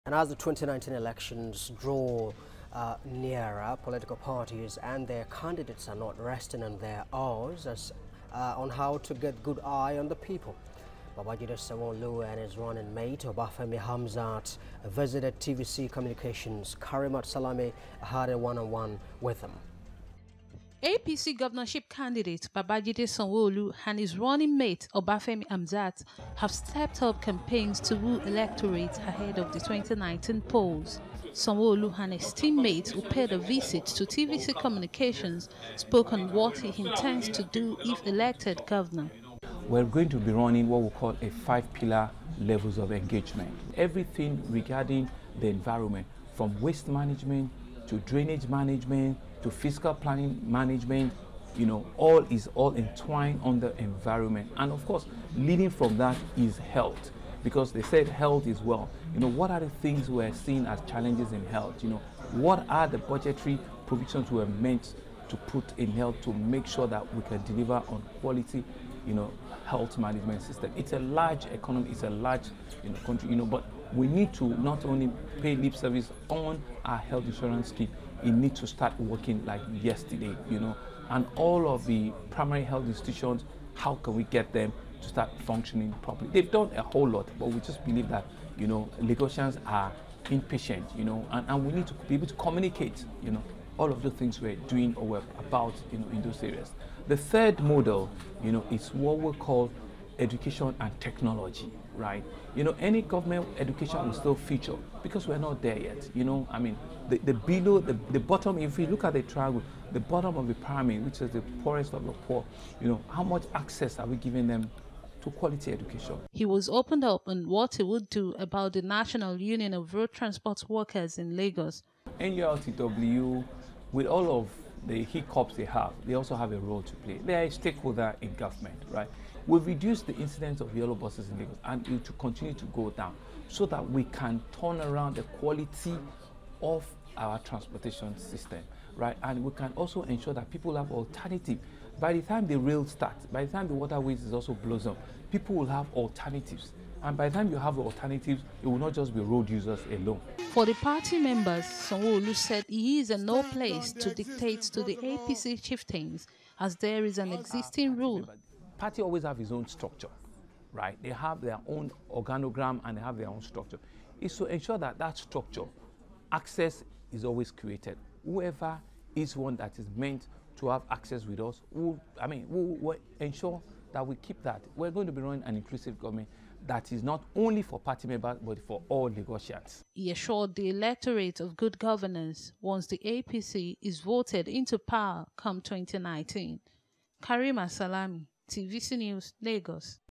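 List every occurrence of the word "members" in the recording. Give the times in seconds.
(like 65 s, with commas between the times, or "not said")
151 s, 178 s.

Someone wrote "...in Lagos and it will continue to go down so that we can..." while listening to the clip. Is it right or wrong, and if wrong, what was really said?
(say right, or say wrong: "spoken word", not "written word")
right.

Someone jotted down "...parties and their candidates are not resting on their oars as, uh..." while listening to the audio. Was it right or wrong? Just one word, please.
right.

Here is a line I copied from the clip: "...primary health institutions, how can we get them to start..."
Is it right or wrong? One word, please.
right.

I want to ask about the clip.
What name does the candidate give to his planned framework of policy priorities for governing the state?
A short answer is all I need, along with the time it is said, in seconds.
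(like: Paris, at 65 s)
five-pillar levels of engagement, at 41 s.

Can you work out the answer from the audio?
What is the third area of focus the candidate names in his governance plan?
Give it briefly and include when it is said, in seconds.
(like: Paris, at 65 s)
education and technology, at 100 s.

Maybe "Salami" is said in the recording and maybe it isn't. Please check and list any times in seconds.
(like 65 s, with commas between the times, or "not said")
17 s, 187 s.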